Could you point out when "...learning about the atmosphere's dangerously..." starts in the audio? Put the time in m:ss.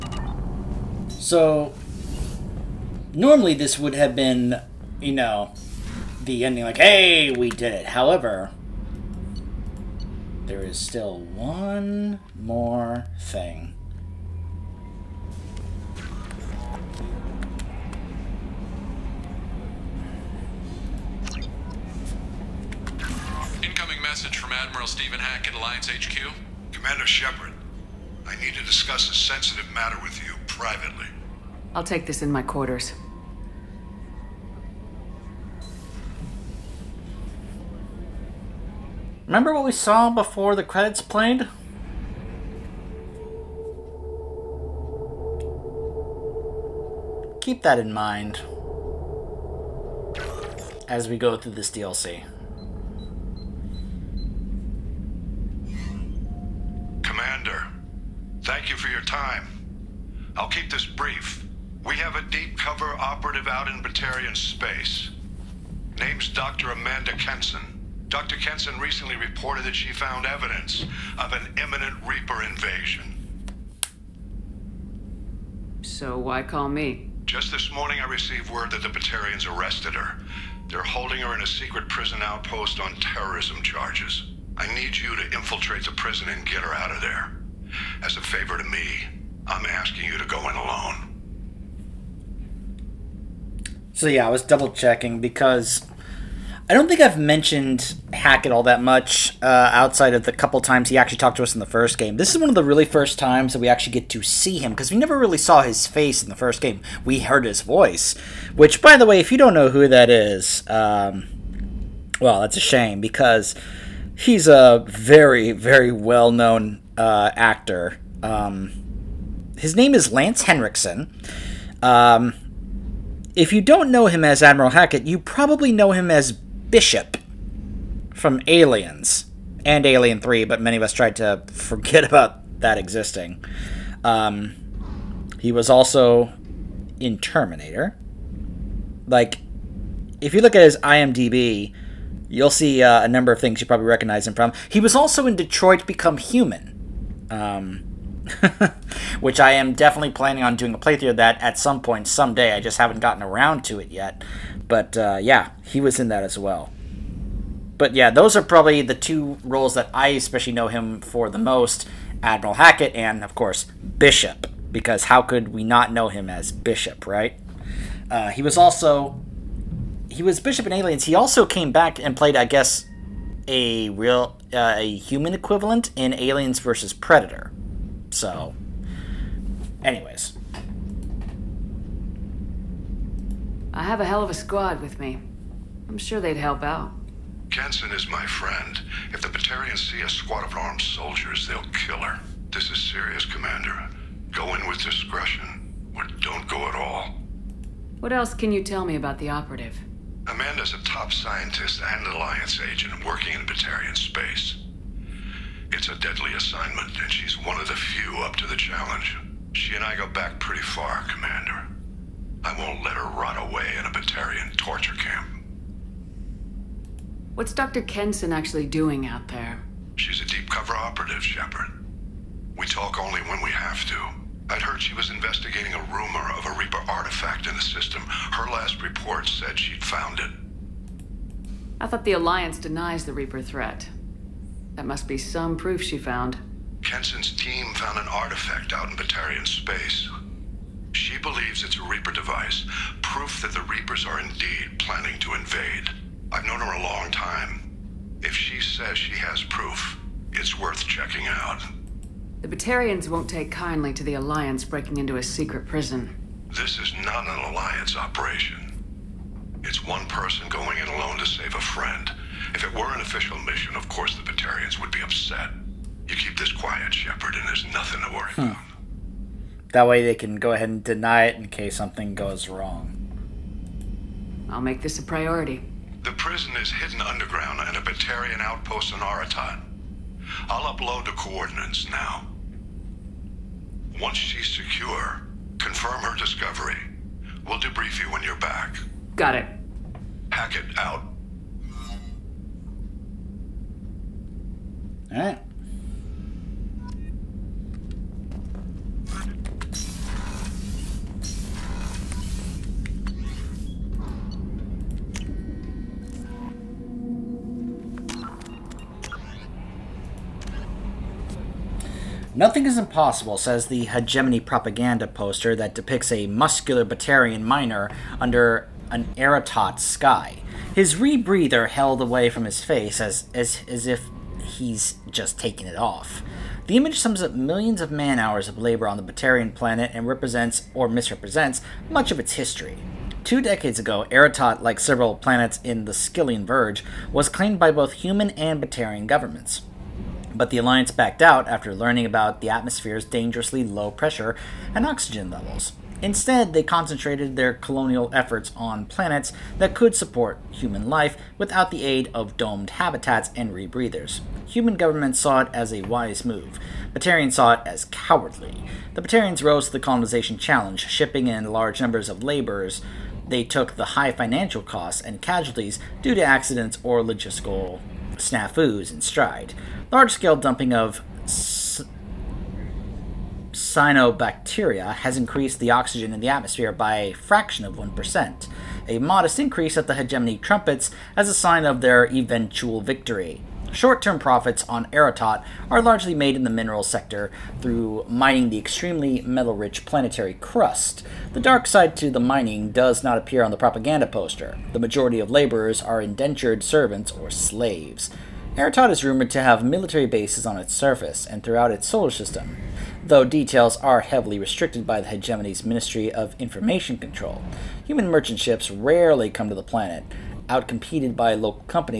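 5:41.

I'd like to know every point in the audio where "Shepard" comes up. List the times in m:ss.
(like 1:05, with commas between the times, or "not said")
0:27, 3:41, 4:26.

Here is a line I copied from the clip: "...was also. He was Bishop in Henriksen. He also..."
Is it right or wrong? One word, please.
wrong.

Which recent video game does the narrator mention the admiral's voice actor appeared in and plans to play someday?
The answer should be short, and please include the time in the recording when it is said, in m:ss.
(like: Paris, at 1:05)
Detroit Become Human, at 2:25.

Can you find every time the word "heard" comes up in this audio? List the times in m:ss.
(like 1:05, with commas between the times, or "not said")
1:47, 3:44.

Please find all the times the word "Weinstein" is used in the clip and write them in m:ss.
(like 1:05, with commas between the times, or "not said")
not said.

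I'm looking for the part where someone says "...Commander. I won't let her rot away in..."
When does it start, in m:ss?
3:31.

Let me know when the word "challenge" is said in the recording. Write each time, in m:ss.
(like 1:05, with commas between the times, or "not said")
3:28, 6:00.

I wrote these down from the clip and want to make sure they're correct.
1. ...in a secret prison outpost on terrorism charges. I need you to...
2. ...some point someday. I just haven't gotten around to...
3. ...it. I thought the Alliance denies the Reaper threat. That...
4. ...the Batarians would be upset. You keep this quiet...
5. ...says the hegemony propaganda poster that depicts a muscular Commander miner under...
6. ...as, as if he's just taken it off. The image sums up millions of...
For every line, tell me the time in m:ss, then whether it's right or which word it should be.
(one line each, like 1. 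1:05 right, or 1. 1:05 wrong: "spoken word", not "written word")
1. 1:21 right
2. 2:31 right
3. 3:50 right
4. 4:24 right
5. 5:13 wrong: "Batarian", not "Commander"
6. 5:23 right.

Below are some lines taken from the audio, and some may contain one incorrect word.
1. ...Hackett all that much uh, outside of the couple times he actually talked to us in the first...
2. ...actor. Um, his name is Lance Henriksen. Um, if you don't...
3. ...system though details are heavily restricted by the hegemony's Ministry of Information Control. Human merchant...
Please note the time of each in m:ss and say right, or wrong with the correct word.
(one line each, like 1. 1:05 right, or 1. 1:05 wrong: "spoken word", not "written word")
1. 1:38 right
2. 1:57 right
3. 6:42 right.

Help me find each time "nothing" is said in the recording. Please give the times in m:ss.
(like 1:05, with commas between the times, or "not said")
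4:27, 5:12.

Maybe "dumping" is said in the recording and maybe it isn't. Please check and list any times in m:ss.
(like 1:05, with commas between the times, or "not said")
6:10.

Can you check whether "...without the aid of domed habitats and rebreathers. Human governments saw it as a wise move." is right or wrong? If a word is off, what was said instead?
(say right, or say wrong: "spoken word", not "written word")
right.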